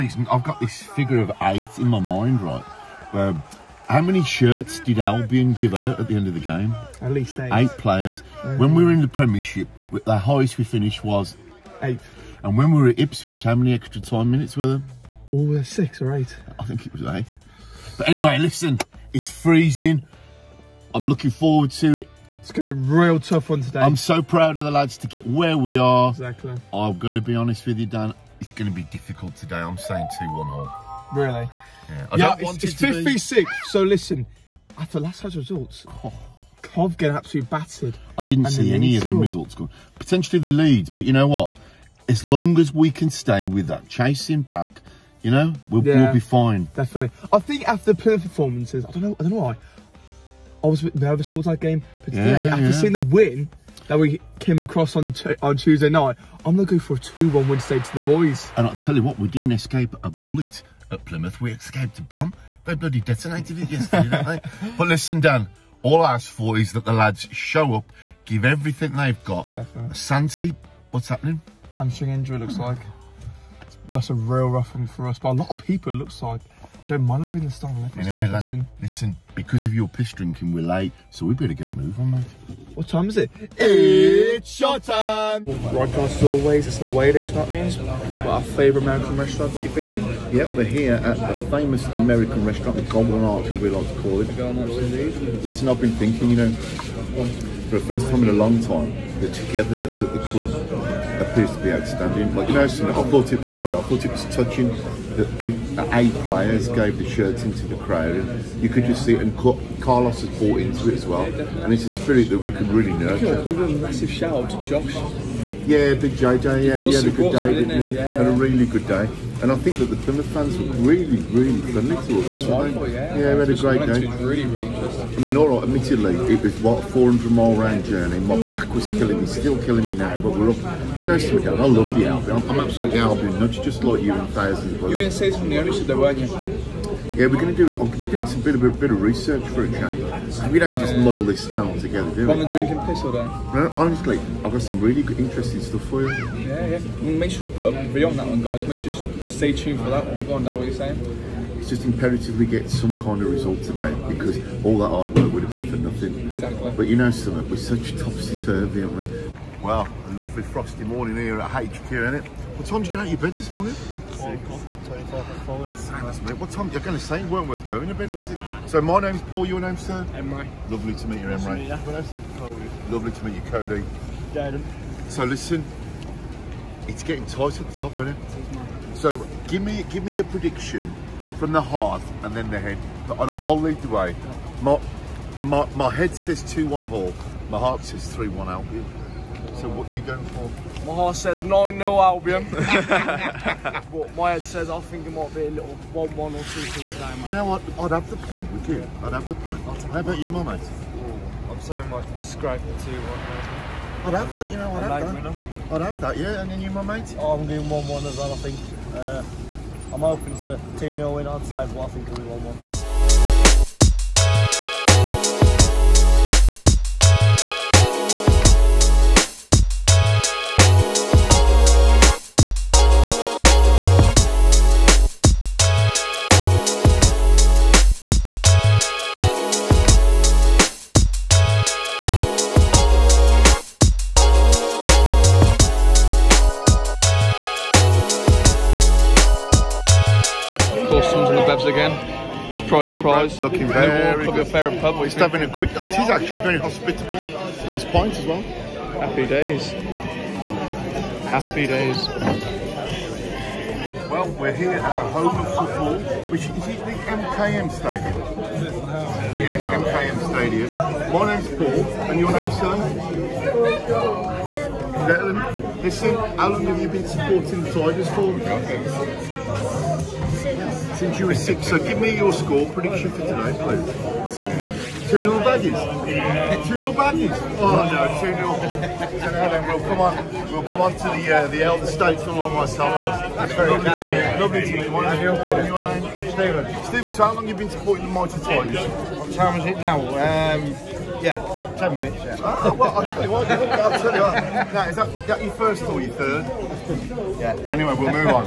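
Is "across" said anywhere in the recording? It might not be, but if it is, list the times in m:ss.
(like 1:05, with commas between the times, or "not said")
0:54.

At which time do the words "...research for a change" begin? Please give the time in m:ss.
2:19.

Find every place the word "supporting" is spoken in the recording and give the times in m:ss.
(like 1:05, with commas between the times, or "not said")
4:27, 4:47.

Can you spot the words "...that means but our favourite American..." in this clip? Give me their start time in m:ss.
1:27.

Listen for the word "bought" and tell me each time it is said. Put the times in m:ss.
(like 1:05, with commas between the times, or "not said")
1:50.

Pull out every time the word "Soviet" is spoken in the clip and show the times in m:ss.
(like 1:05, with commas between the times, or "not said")
not said.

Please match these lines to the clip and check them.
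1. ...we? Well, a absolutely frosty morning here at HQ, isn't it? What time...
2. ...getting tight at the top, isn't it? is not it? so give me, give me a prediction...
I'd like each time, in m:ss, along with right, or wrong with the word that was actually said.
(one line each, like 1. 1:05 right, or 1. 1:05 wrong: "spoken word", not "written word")
1. 2:38 wrong: "lovely", not "absolutely"
2. 2:57 right.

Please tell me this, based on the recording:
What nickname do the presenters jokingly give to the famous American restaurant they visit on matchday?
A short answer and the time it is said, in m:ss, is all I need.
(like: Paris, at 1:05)
The Goblin Arch, at 1:32.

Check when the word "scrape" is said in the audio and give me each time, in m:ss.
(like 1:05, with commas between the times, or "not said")
3:22.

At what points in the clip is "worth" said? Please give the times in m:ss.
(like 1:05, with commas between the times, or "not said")
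2:47.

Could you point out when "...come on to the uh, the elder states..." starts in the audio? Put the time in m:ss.
4:40.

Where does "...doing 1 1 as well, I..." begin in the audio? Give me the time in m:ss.
3:27.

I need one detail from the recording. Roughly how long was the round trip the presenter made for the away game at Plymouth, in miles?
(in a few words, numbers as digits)
400 miles.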